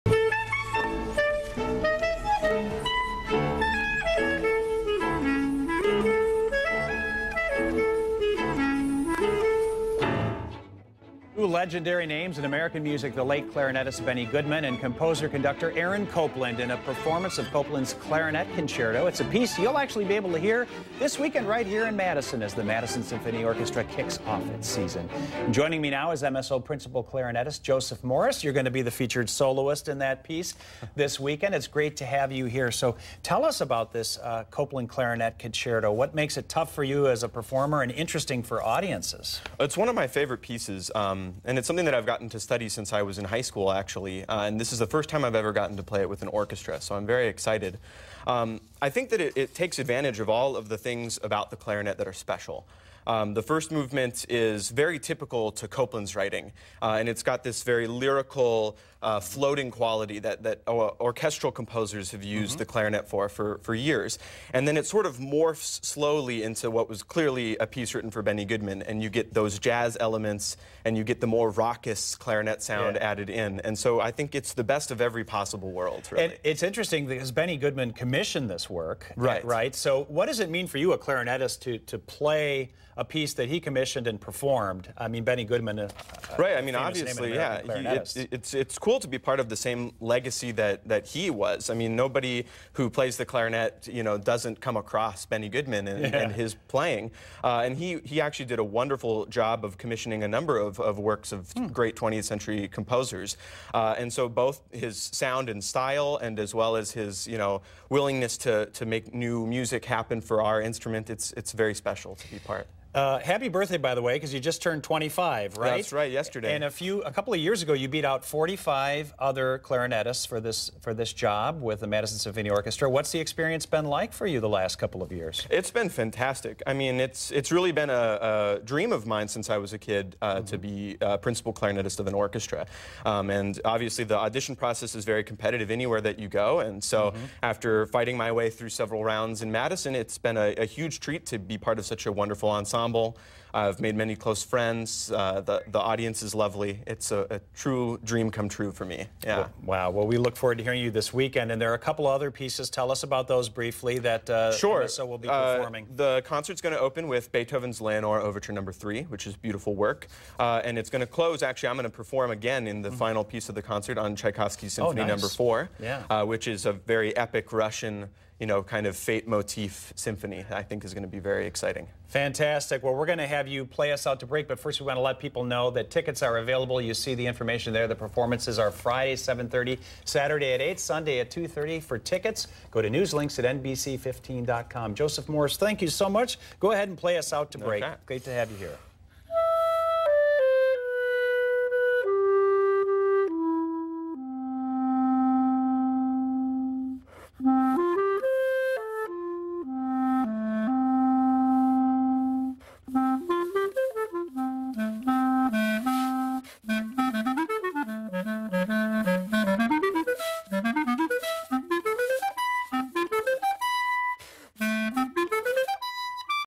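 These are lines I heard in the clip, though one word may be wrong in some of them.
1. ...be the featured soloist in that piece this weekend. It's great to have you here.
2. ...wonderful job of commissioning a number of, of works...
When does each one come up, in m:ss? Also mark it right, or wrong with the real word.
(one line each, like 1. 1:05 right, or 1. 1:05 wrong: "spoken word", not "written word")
1. 0:28 right
2. 1:38 right.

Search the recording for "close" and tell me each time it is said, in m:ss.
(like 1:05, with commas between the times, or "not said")
2:24, 2:41.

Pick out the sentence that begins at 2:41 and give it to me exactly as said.
Actually, I'm going to perform again in the mm -hmm.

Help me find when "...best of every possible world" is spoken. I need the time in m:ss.
1:14.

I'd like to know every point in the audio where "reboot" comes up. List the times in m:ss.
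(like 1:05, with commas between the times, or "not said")
not said.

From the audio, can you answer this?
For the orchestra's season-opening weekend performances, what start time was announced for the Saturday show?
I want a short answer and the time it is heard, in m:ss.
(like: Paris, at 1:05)
8, at 3:00.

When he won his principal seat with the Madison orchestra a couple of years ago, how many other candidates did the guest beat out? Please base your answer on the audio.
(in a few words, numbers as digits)
45.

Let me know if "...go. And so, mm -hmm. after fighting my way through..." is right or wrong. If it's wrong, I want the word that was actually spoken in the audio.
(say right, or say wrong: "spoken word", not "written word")
right.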